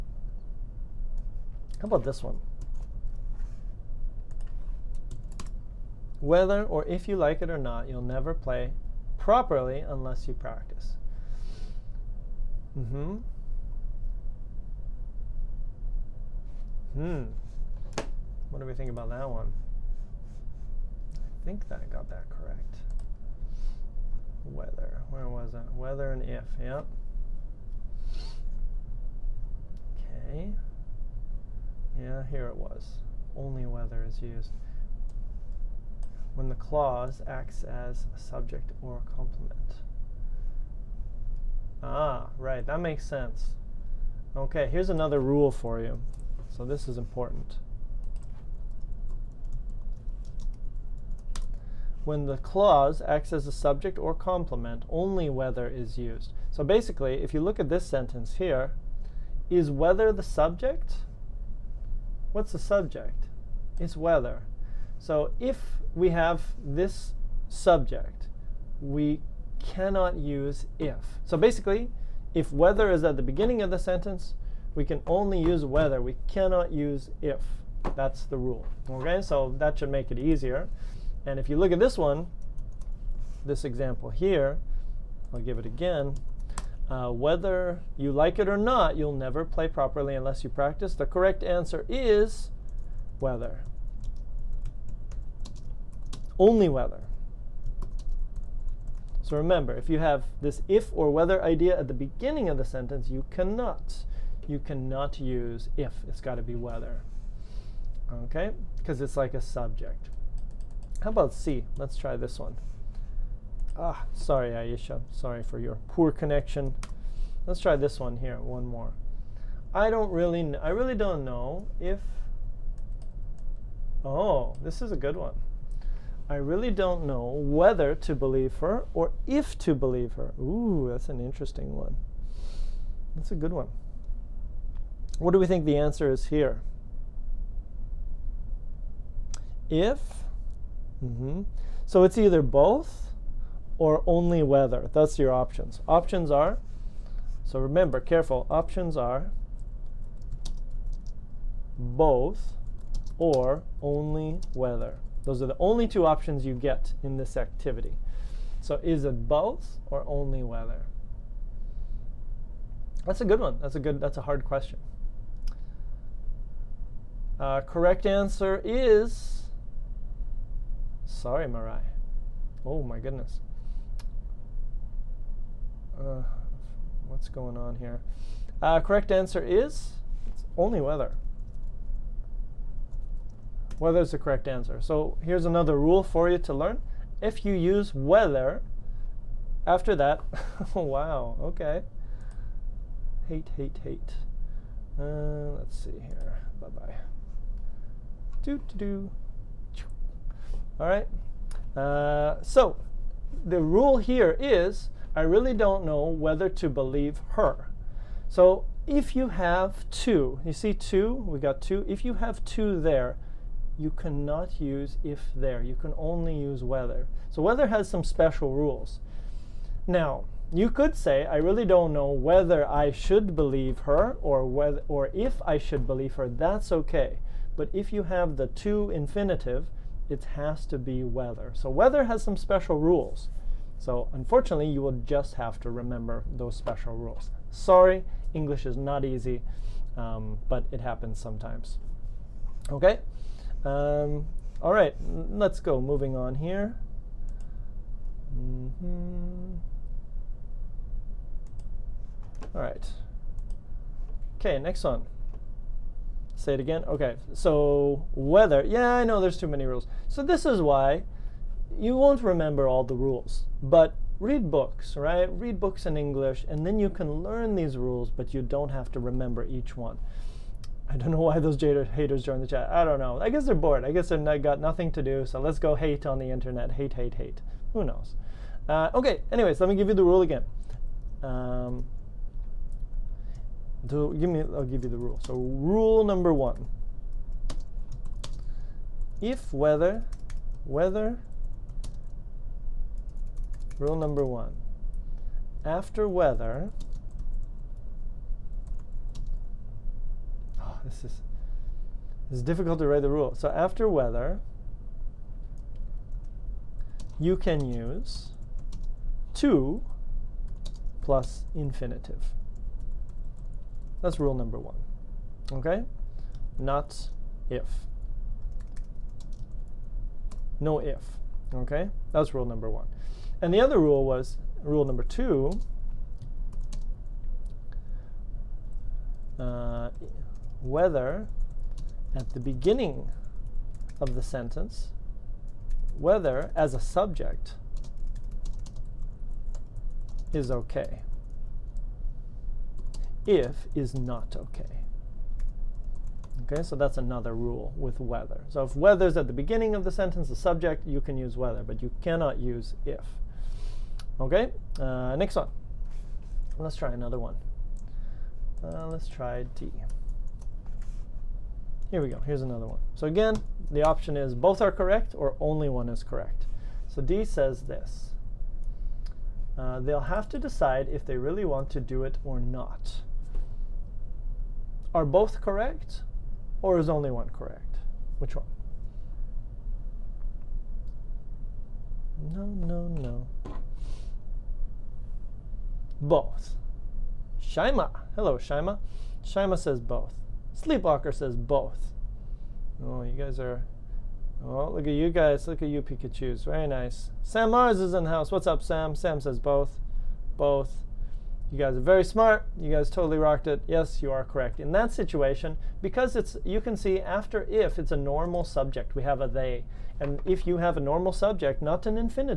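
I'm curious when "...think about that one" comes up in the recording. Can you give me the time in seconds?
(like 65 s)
18 s.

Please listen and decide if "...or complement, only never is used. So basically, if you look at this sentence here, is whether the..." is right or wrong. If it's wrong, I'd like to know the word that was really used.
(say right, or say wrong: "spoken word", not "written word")
wrong: "whether", not "never".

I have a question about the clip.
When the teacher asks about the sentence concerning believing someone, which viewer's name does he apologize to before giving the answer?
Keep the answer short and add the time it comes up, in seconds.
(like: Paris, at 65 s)
Marai, at 171 s.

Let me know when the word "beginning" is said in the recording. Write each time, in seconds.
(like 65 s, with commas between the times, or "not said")
73 s, 101 s, 332 s, 349 s.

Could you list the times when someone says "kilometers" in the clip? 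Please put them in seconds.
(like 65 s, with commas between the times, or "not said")
not said.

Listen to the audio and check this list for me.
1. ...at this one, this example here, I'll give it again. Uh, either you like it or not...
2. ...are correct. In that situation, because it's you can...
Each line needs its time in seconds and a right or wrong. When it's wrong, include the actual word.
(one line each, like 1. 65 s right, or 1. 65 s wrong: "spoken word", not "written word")
1. 81 s wrong: "whether", not "either"
2. 404 s right.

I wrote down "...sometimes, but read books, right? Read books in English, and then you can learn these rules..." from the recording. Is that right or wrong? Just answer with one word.
wrong.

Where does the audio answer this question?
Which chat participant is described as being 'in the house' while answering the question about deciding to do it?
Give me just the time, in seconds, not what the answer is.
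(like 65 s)
397 s.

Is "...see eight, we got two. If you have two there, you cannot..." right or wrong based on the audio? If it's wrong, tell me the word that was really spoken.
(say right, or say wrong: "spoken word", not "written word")
wrong: "two", not "eight".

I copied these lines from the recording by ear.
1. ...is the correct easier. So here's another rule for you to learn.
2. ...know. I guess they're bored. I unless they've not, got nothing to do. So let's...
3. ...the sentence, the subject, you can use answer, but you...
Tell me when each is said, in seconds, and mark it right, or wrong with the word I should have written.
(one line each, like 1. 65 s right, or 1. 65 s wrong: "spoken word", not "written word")
1. 184 s wrong: "answer", not "easier"
2. 272 s wrong: "guess", not "unless"
3. 349 s wrong: "whether", not "answer".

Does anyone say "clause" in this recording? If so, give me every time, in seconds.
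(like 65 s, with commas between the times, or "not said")
36 s, 52 s.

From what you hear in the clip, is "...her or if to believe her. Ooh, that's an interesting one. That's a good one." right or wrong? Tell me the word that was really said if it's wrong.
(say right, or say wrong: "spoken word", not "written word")
right.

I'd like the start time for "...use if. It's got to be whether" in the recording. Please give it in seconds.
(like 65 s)
105 s.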